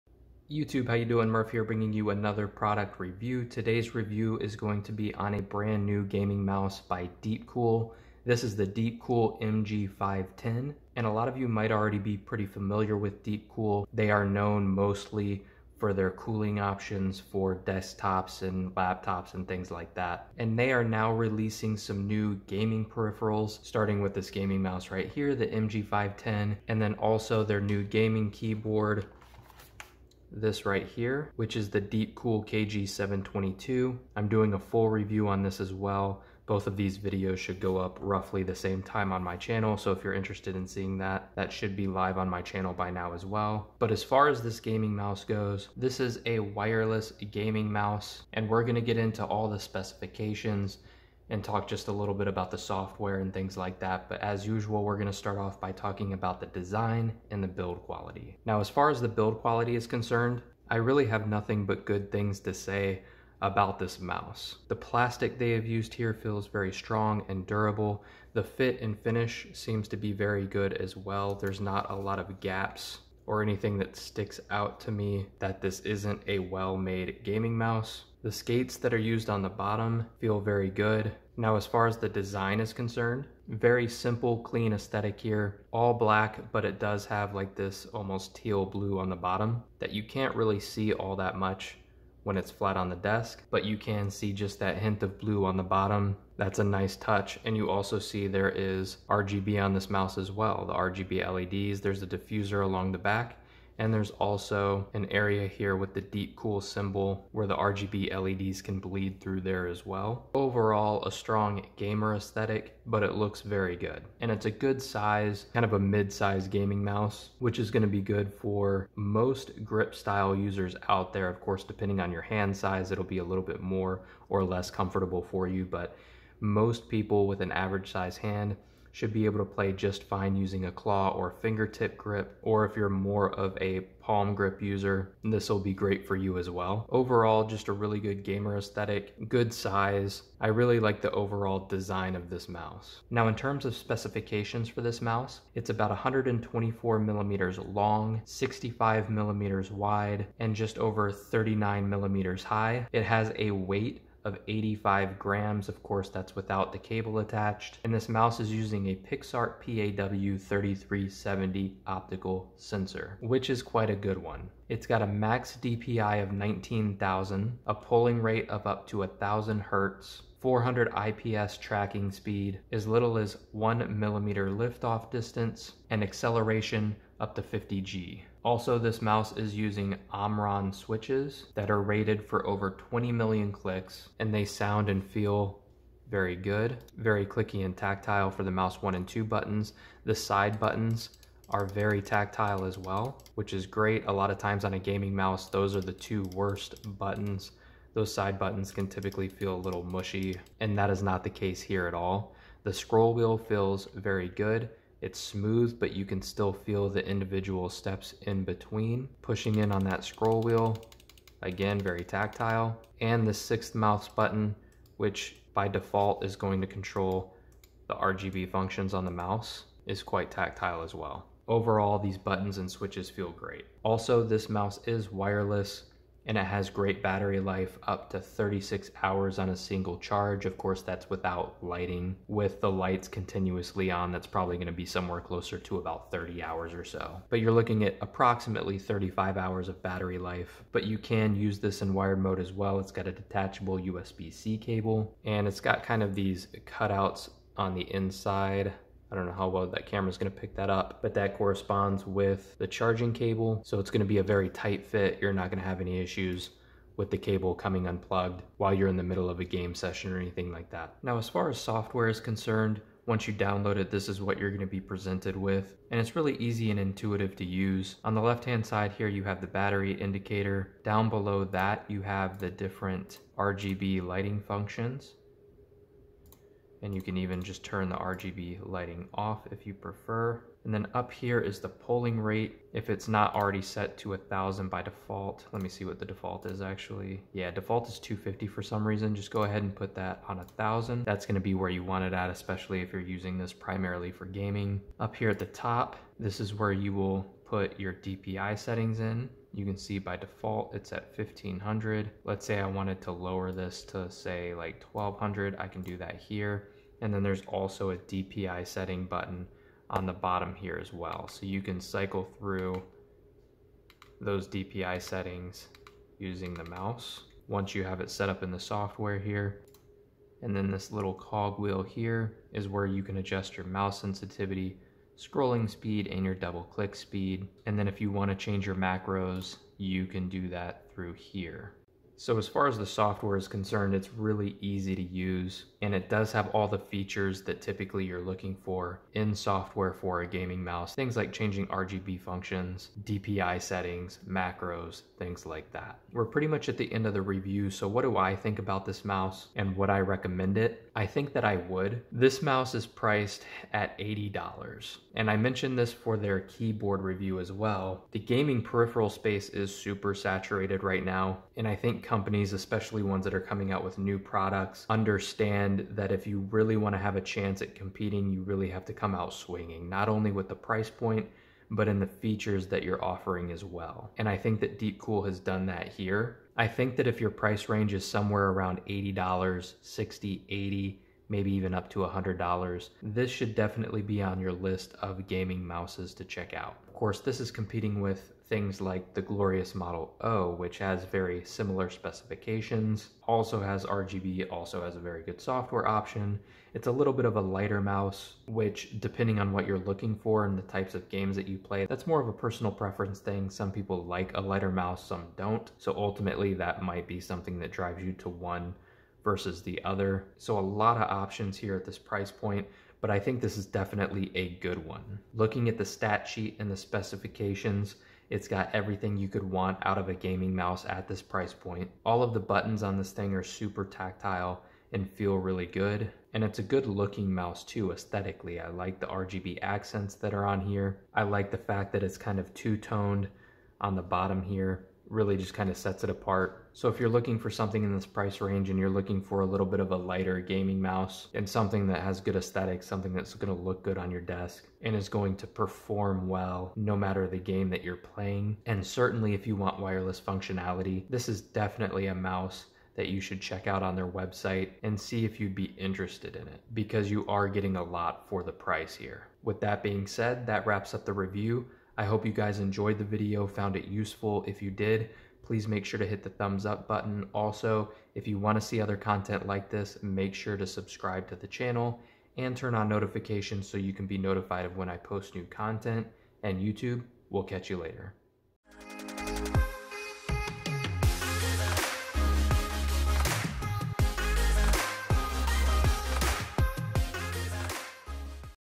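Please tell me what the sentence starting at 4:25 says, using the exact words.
And it's really easy and intuitive to use.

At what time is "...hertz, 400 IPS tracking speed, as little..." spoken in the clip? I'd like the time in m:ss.
2:49.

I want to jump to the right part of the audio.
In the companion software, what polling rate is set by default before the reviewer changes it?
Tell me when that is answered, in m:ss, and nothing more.
4:47.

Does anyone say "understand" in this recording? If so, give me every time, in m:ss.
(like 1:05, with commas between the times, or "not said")
6:04.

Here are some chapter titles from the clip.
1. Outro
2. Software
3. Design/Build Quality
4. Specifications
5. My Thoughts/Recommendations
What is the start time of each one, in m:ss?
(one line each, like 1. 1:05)
1. 7:35
2. 4:20
3. 0:55
4. 2:20
5. 5:45.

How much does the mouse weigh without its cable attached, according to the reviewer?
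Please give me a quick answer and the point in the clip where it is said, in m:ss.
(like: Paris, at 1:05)
85 grams, at 2:34.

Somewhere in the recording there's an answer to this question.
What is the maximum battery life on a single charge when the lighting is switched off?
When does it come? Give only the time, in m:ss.
3:48.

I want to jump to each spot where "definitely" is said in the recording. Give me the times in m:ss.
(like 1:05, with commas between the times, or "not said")
6:23, 6:53, 7:31.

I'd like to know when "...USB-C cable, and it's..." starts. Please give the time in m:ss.
4:03.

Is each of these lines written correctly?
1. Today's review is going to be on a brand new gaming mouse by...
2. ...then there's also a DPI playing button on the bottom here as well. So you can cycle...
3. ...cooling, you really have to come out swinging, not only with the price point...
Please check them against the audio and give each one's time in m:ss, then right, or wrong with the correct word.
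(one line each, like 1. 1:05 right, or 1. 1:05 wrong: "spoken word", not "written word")
1. 0:03 right
2. 5:07 wrong: "setting", not "playing"
3. 6:07 wrong: "competing", not "cooling".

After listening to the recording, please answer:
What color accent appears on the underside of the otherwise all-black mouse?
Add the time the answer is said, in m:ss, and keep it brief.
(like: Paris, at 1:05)
teal blue, at 1:28.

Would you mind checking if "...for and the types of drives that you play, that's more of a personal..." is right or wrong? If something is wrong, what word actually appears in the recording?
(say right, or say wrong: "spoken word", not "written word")
wrong: "games", not "drives".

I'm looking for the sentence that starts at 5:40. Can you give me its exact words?
Things like changing RGB functions, DPI settings, macros, things like that.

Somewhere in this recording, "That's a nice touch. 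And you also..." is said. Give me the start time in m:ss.
1:36.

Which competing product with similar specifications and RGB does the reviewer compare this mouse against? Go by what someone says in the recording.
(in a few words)
Glorious Model O.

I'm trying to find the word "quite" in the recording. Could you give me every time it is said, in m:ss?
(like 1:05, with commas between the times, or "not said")
2:43, 3:40.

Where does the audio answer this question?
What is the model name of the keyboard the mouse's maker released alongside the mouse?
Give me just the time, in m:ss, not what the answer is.
0:32.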